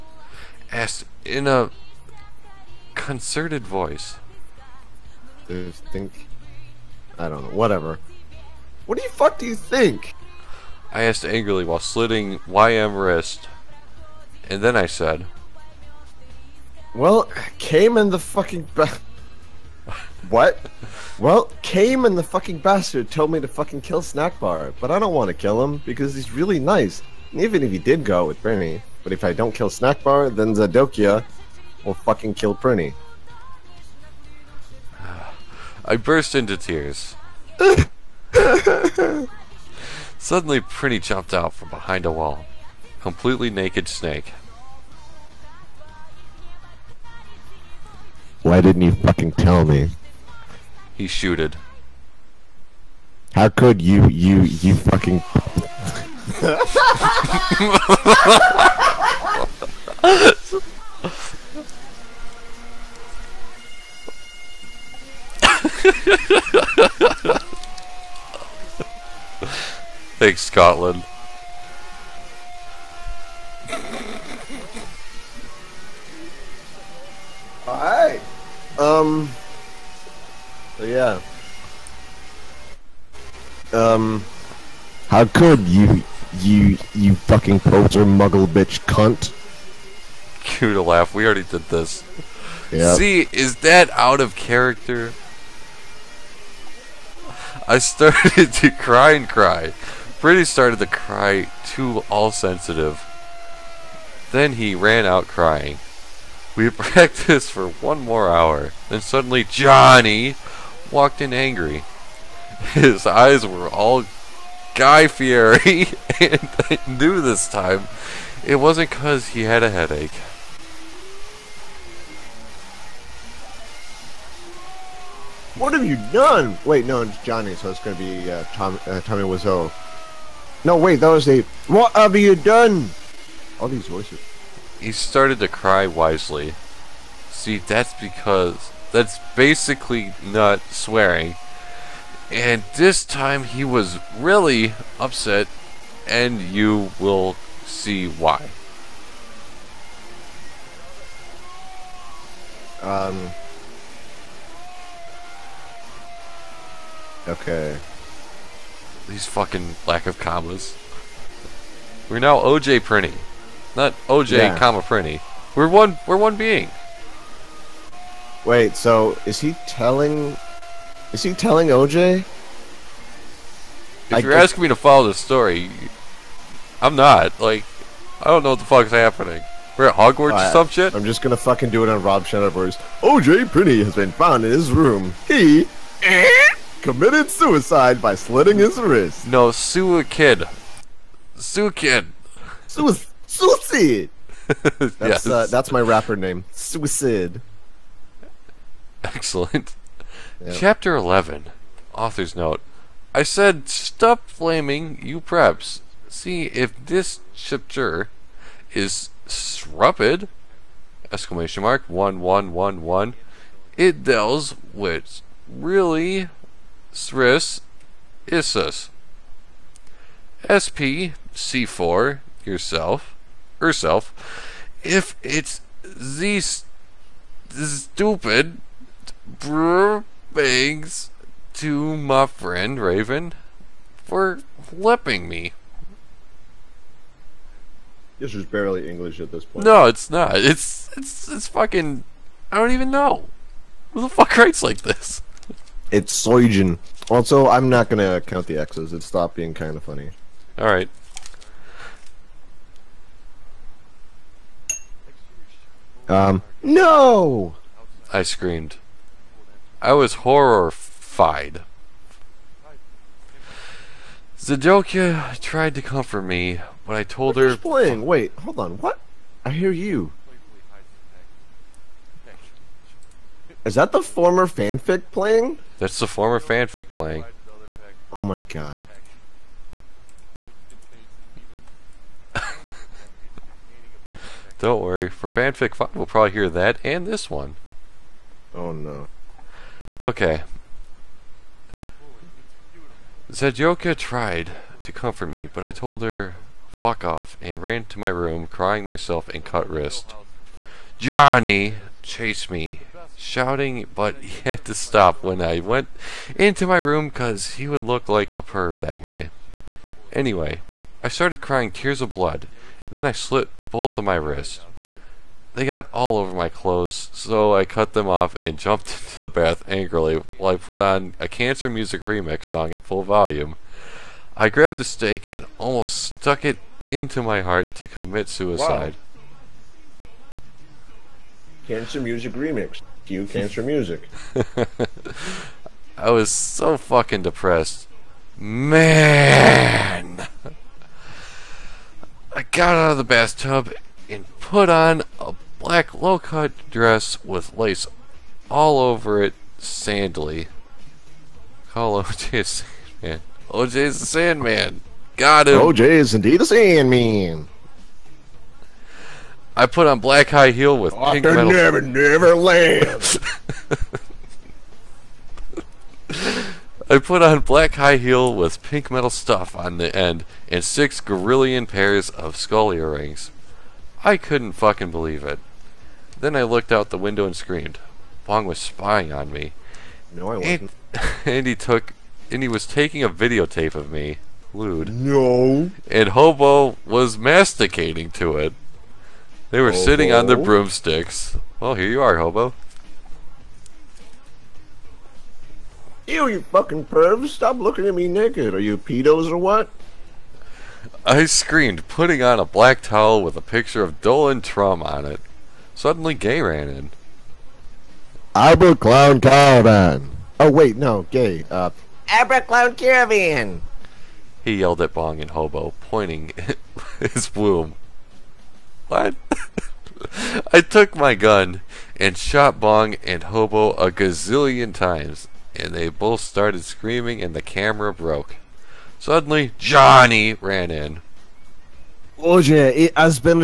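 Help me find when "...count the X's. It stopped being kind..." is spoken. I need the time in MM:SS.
04:08.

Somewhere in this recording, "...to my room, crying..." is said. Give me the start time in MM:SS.
04:57.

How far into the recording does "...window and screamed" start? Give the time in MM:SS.
06:16.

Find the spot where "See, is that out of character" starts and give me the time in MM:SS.
01:32.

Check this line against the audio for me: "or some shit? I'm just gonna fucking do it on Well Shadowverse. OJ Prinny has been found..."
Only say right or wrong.
wrong.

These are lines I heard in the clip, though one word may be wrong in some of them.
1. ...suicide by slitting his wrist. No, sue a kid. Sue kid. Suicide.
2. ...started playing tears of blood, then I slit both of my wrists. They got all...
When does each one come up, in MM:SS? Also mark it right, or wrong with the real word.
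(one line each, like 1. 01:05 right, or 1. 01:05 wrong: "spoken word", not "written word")
1. 03:07 right
2. 05:11 wrong: "crying", not "playing".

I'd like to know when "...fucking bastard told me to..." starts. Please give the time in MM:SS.
00:22.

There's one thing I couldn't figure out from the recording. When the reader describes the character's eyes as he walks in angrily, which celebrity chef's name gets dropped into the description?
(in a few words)
Guy Fieri.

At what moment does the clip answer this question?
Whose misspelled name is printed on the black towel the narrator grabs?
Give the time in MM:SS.
06:44.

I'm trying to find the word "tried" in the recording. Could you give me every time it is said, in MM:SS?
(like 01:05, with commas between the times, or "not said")
04:25, 04:53.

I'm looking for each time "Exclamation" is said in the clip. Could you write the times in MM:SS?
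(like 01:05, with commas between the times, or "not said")
03:31.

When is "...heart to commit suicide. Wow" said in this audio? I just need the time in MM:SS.
05:27.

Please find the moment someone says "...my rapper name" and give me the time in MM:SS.
03:15.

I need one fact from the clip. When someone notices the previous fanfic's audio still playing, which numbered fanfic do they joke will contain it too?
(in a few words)
5.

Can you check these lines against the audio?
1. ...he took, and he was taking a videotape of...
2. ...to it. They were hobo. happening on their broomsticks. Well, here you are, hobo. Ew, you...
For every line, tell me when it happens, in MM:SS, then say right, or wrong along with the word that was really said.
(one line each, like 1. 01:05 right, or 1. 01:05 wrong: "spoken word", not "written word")
1. 06:21 right
2. 06:28 wrong: "sitting", not "happening".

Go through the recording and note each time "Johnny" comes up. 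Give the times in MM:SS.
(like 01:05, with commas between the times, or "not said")
01:49, 02:07, 05:00, 07:09.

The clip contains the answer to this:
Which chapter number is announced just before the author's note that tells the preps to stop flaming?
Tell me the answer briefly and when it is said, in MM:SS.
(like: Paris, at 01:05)
11, at 03:20.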